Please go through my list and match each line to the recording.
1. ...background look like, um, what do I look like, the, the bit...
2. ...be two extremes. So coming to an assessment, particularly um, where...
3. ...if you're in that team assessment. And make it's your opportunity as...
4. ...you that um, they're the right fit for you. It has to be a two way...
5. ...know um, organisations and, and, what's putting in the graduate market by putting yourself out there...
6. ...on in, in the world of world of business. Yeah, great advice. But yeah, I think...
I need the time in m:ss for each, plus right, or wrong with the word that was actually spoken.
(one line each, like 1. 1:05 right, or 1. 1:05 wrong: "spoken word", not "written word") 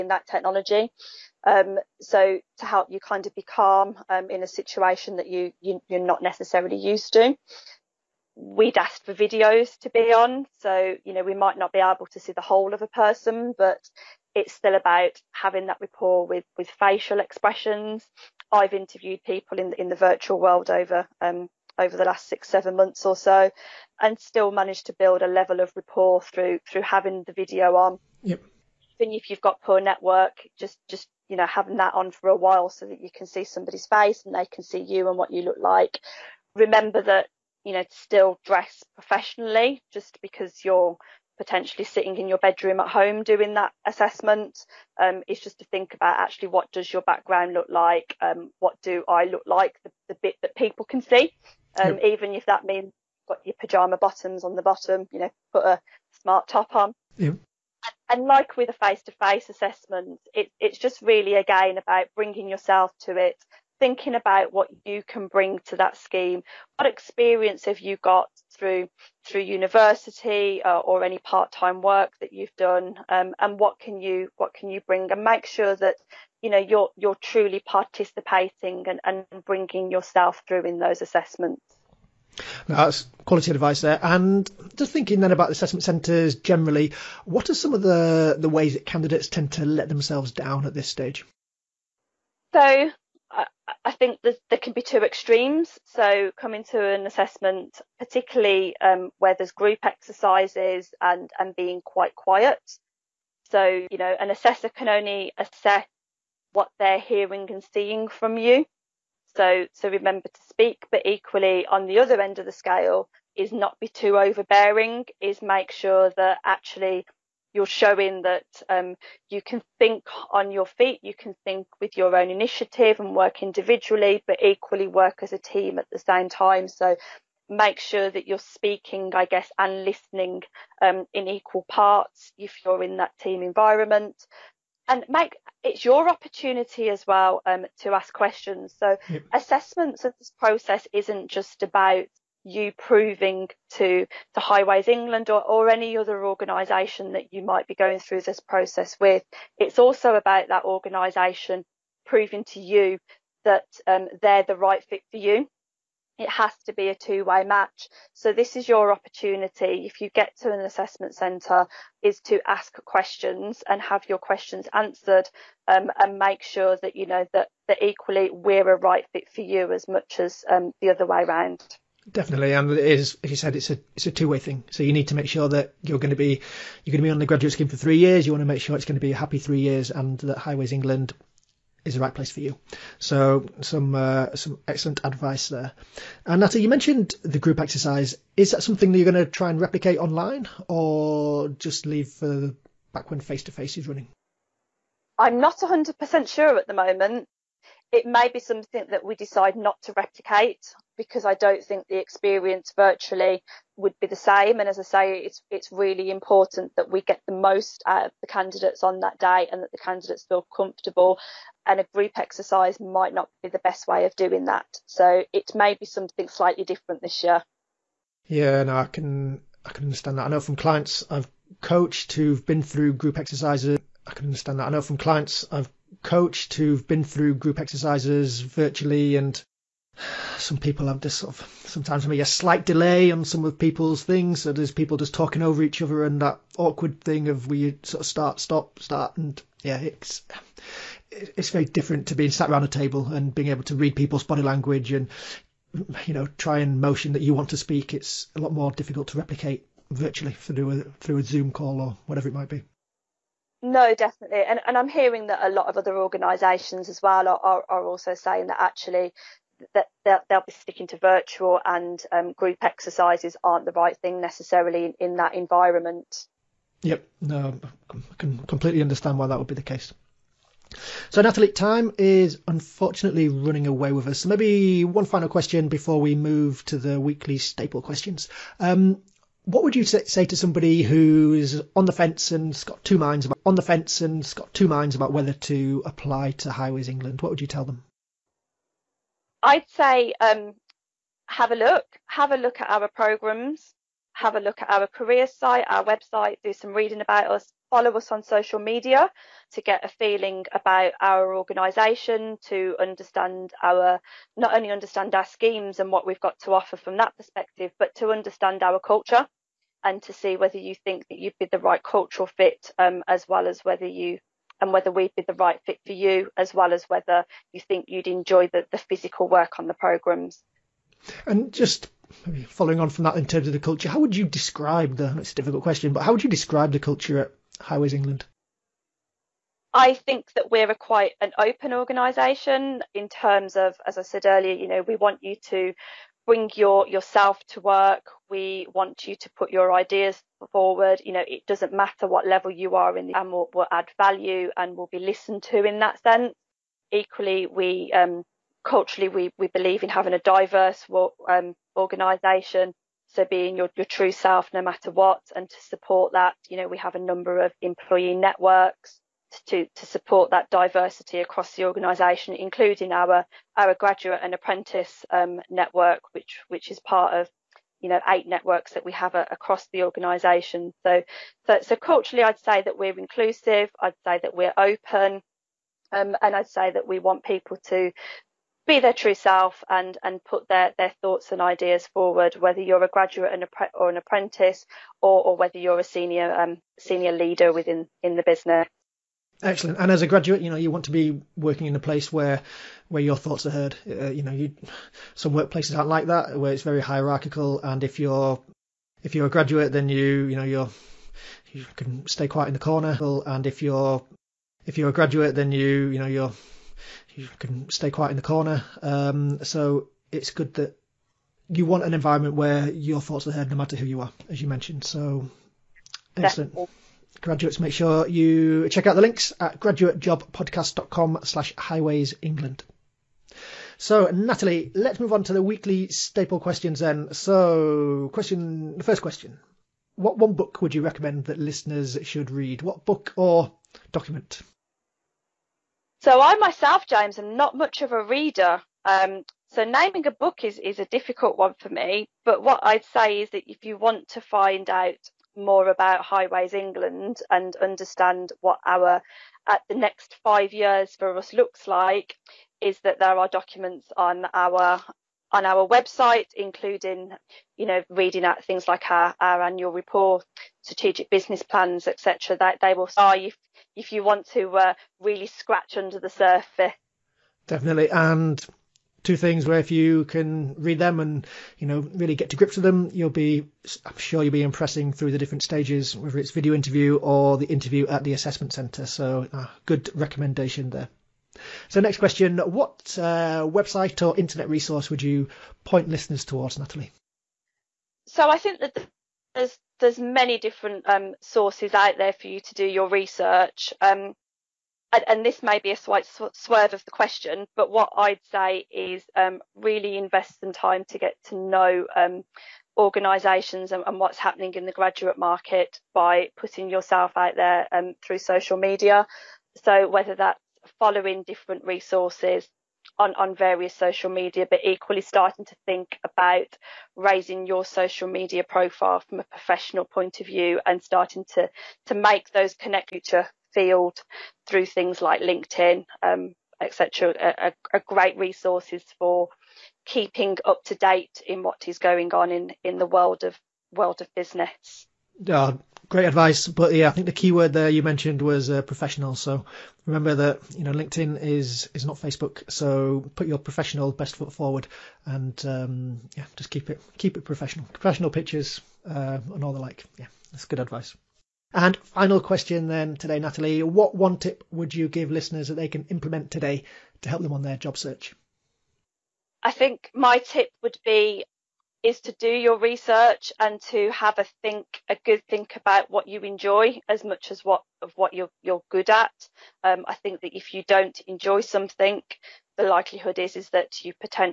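1. 0:47 right
2. 1:34 right
3. 2:12 wrong: "environment", not "assessment"
4. 2:32 right
5. 8:21 wrong: "happening", not "putting"
6. 8:52 right.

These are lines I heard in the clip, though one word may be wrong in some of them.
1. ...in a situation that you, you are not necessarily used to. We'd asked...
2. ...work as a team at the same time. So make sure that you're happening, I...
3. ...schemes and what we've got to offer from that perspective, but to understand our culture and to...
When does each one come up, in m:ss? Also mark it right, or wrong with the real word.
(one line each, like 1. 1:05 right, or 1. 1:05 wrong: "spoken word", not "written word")
1. 0:04 right
2. 2:04 wrong: "speaking", not "happening"
3. 5:05 right.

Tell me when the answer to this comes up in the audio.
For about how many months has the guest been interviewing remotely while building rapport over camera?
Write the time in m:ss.
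0:22.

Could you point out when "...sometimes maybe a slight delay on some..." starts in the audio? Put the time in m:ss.
3:51.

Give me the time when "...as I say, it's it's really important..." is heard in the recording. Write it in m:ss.
3:24.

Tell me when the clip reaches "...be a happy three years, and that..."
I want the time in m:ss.
2:59.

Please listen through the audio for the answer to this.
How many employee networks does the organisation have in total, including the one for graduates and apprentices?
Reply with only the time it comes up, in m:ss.
6:08.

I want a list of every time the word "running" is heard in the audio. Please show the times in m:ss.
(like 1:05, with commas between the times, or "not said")
3:13, 4:33.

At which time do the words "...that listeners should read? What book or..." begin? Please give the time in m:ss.
7:11.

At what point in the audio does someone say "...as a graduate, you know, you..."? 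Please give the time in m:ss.
6:29.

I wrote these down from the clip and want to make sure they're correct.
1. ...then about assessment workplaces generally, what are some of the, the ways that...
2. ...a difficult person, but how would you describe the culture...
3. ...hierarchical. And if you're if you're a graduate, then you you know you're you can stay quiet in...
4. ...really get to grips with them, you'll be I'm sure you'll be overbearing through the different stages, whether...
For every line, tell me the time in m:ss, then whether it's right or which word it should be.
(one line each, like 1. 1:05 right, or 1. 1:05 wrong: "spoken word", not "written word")
1. 1:25 wrong: "centres", not "workplaces"
2. 5:25 wrong: "question", not "person"
3. 6:36 right
4. 7:51 wrong: "impressing", not "overbearing".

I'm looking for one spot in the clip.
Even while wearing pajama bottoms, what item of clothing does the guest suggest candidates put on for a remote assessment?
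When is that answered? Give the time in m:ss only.
0:56.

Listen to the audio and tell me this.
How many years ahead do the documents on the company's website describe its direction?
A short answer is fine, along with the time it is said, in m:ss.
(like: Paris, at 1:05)
5, at 7:29.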